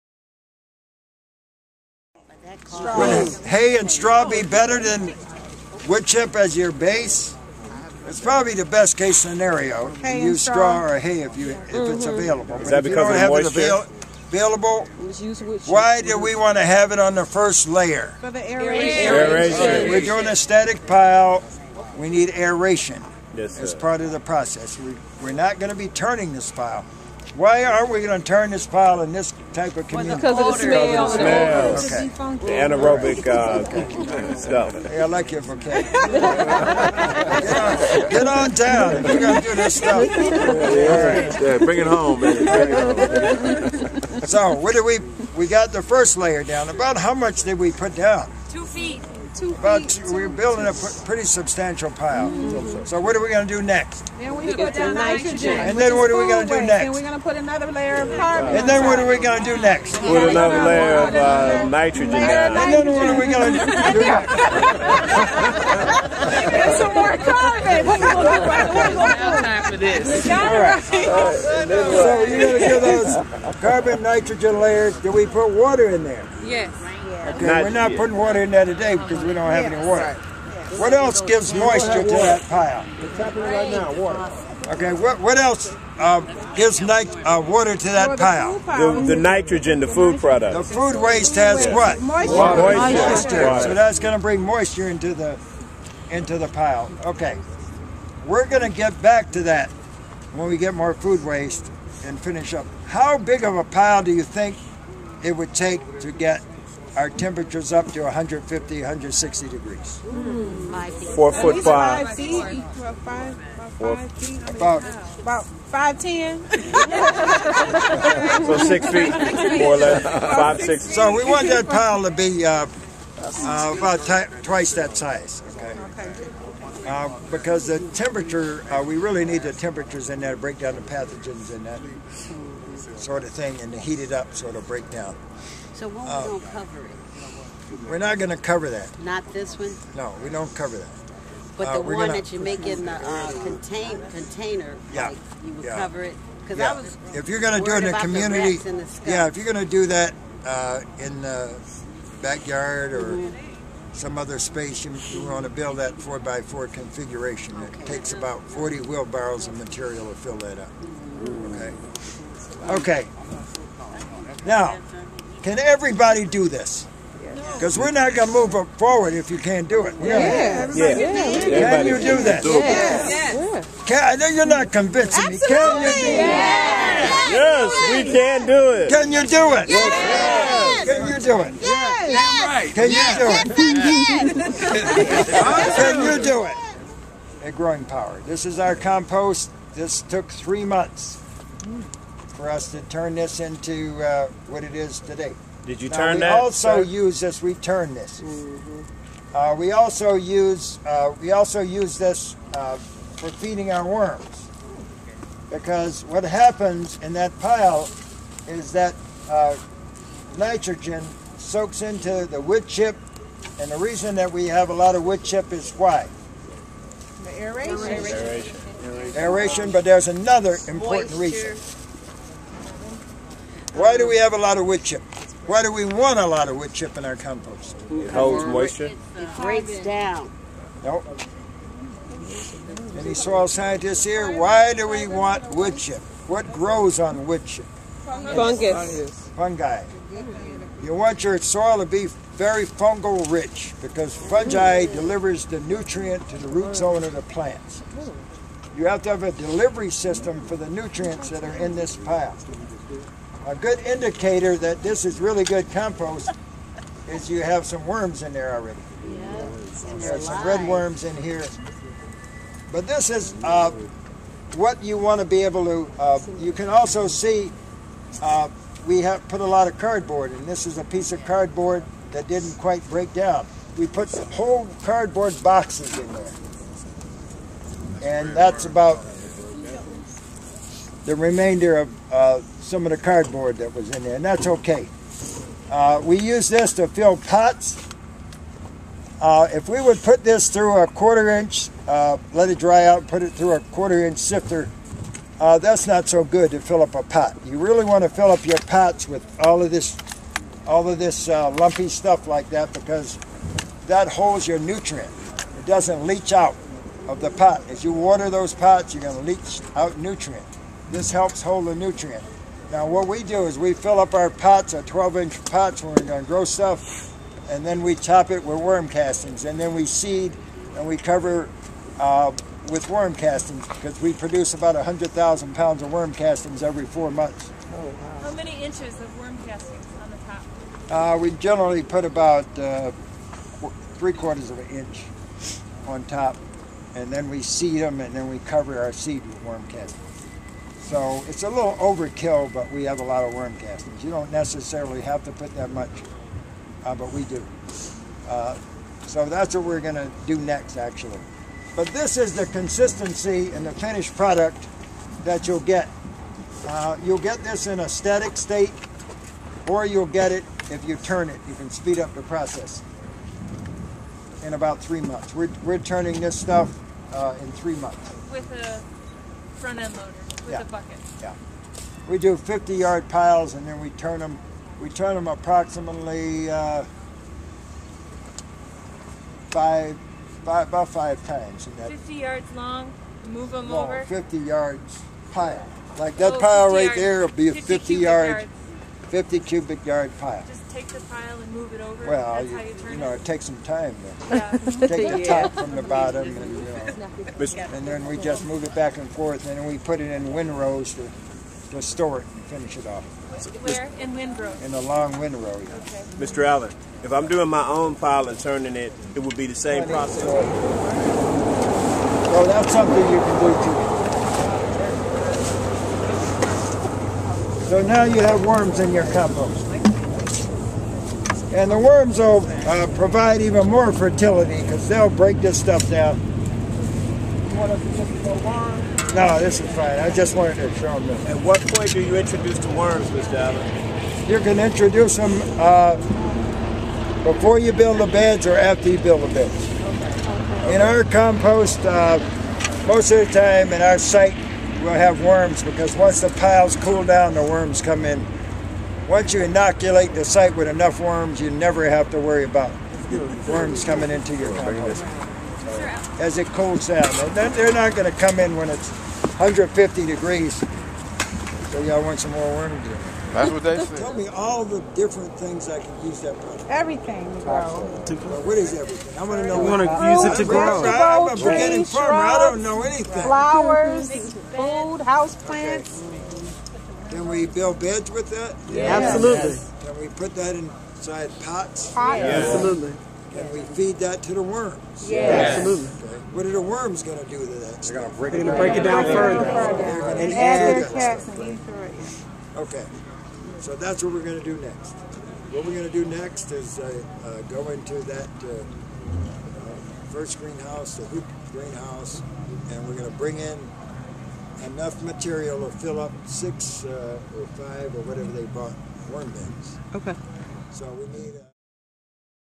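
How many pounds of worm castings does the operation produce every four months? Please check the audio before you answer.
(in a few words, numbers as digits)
100,000.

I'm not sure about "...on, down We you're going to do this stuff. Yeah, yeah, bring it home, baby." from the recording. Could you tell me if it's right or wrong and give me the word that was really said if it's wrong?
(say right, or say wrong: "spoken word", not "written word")
right.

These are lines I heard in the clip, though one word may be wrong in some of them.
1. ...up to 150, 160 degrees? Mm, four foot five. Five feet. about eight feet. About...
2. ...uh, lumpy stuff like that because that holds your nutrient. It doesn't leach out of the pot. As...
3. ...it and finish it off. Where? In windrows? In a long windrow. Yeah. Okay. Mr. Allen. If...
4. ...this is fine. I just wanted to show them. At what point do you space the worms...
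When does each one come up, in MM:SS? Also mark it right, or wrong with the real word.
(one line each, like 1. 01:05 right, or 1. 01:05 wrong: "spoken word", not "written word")
1. 01:47 wrong: "five", not "eight"
2. 05:01 right
3. 06:42 right
4. 07:09 wrong: "introduce", not "space".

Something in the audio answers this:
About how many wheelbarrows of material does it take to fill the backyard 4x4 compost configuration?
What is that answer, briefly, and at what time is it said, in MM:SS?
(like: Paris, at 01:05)
40, at 02:38.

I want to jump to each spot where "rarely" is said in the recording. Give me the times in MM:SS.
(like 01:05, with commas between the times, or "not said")
not said.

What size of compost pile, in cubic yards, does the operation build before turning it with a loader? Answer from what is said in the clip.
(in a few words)
50 cubic yards.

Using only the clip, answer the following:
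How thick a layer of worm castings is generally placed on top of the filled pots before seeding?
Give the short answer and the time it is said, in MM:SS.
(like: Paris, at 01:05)
Three quarters of an inch, at 05:33.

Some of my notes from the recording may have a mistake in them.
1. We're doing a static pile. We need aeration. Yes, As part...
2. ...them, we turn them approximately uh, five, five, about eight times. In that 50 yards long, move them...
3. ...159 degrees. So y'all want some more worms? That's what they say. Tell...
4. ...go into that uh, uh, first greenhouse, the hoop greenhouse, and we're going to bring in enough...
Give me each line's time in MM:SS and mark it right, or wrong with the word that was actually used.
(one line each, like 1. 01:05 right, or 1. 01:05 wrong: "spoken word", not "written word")
1. 00:19 right
2. 06:14 wrong: "five", not "eight"
3. 07:38 wrong: "150", not "159"
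4. 08:17 right.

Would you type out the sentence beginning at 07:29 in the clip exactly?
Once you inoculate the site with enough worms, you never have to worry about worms coming into your compost.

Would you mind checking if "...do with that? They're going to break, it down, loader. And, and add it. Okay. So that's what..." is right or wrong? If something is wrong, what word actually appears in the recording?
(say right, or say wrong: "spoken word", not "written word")
wrong: "further", not "loader".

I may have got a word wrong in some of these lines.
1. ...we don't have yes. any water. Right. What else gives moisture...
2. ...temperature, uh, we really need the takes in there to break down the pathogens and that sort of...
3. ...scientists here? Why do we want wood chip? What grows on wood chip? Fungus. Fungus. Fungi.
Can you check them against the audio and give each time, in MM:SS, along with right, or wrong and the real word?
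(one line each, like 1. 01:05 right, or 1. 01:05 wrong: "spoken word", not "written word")
1. 01:19 right
2. 02:07 wrong: "temperatures", not "takes"
3. 03:53 right.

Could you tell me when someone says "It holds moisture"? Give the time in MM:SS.
03:47.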